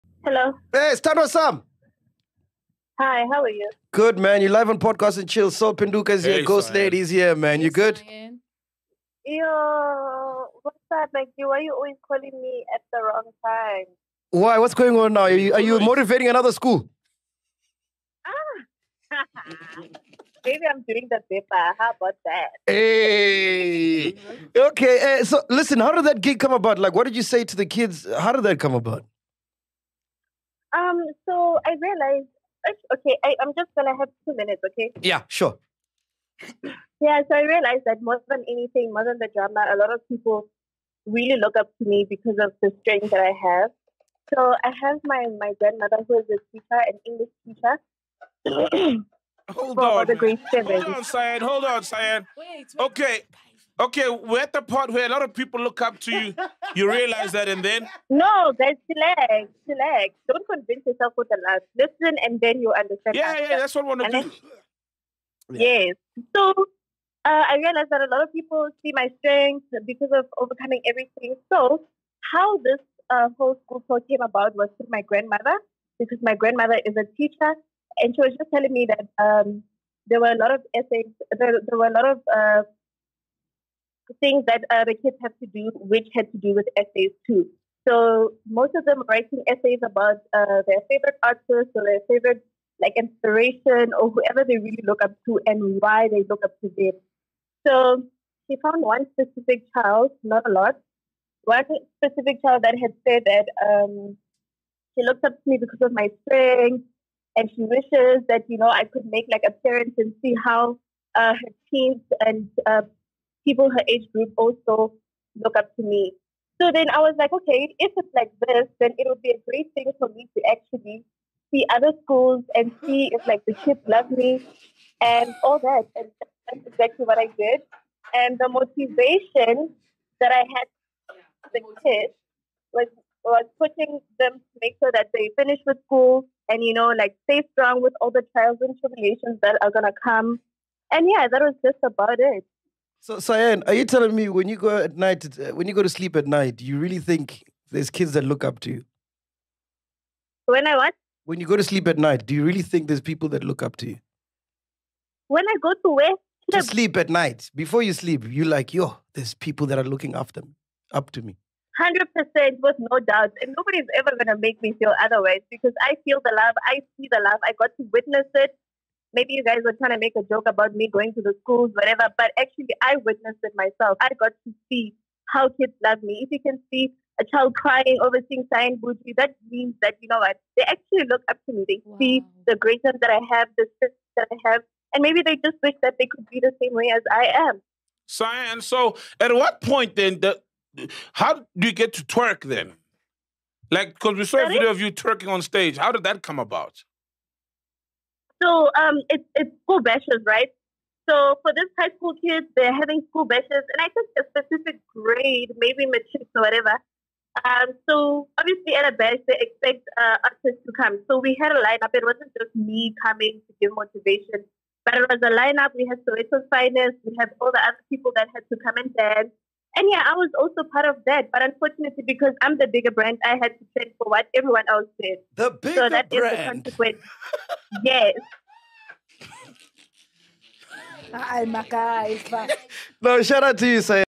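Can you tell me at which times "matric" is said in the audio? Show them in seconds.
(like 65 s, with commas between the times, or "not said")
205 s.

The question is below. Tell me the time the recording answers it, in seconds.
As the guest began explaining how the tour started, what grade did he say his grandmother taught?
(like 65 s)
50 s.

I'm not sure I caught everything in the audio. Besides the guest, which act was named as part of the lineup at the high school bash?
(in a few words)
Soweto Finest.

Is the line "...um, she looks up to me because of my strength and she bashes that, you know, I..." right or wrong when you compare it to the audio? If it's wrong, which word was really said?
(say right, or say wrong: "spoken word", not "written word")
wrong: "wishes", not "bashes".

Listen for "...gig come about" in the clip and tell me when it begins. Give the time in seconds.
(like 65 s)
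26 s.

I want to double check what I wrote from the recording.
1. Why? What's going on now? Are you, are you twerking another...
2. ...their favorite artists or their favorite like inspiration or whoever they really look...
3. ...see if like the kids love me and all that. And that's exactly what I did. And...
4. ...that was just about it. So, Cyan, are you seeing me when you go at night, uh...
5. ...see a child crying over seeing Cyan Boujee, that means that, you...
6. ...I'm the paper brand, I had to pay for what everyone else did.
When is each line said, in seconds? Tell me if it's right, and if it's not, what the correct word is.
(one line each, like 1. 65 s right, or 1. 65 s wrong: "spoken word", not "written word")
1. 14 s wrong: "motivating", not "twerking"
2. 90 s right
3. 122 s right
4. 141 s wrong: "telling", not "seeing"
5. 176 s right
6. 222 s wrong: "bigger", not "paper".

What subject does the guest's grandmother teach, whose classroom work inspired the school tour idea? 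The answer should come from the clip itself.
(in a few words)
English.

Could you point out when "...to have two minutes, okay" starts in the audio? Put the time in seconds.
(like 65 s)
33 s.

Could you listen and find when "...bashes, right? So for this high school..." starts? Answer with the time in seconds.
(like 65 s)
199 s.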